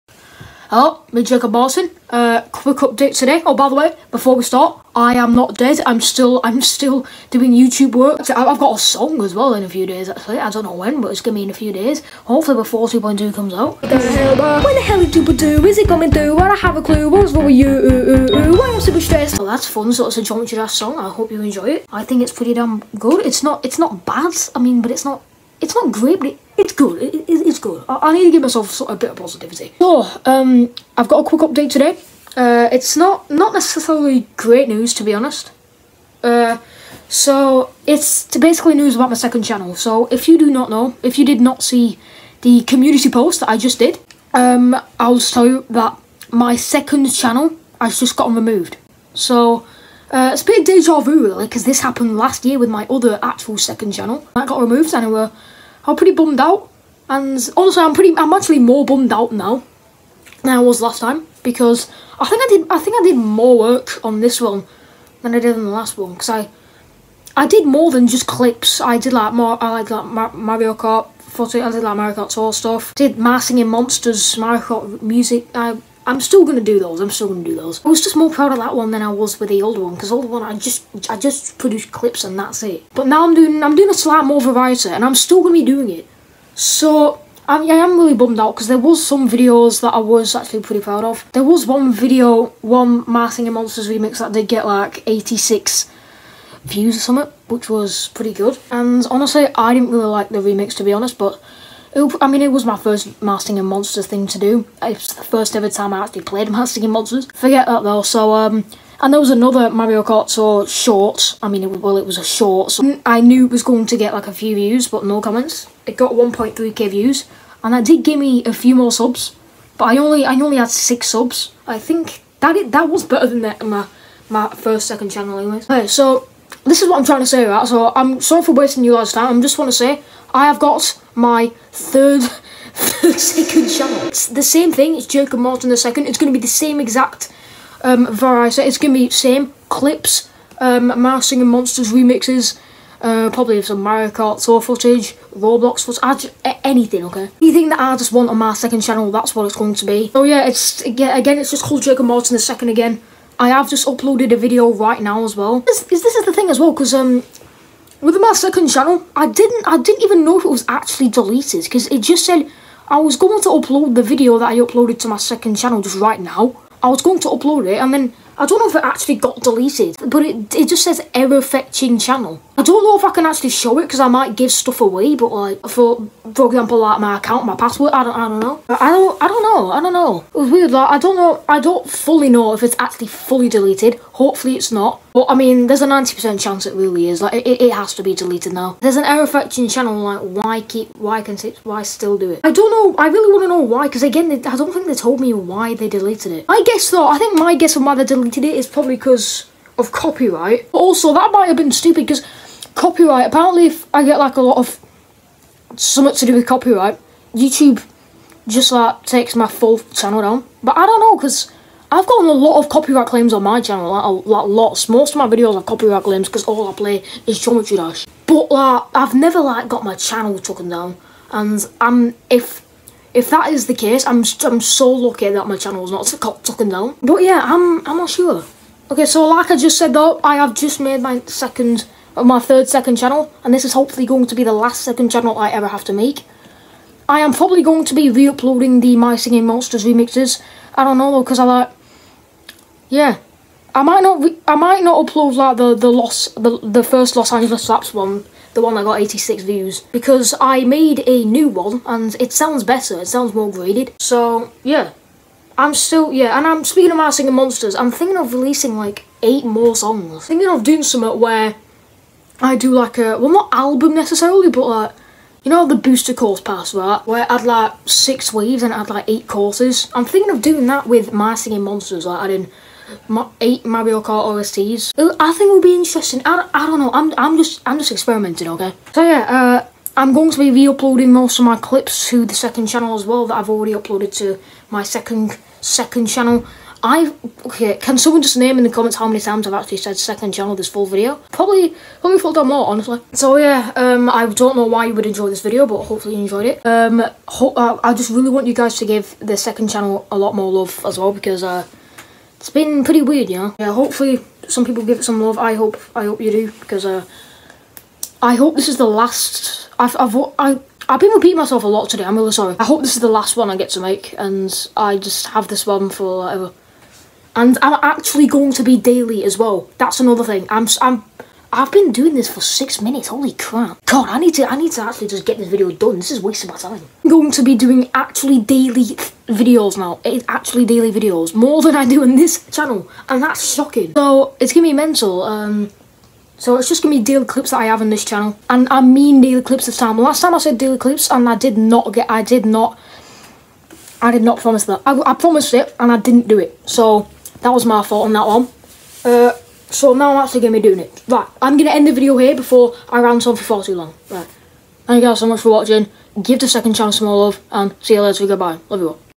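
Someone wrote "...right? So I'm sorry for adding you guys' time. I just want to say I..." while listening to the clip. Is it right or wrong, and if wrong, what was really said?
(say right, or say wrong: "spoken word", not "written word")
wrong: "wasting", not "adding".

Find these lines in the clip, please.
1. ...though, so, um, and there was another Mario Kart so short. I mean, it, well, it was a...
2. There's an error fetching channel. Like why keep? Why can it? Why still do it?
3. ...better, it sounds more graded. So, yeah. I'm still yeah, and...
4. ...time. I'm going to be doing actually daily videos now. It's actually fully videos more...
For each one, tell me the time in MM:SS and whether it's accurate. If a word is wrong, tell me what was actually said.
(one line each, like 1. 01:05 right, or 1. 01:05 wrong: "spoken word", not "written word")
1. 01:47 right
2. 03:08 right
3. 04:12 right
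4. 05:26 wrong: "daily", not "fully".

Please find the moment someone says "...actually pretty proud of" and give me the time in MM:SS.
01:30.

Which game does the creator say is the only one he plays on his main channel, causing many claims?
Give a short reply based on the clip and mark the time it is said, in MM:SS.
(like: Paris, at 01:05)
Geometry Dash, at 03:37.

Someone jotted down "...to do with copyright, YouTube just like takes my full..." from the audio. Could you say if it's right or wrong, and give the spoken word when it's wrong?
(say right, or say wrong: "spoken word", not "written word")
right.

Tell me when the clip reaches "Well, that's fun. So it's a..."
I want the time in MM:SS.
00:19.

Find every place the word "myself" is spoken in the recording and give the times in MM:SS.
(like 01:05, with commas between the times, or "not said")
00:28, 05:11.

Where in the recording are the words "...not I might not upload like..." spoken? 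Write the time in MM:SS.
04:04.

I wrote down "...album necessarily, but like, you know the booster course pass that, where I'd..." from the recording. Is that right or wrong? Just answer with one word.
right.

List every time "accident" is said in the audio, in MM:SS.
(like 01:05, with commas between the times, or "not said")
not said.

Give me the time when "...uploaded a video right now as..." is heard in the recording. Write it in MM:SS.
02:33.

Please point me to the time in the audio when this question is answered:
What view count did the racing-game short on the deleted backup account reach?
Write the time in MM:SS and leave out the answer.
01:56.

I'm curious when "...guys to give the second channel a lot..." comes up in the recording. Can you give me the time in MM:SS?
04:58.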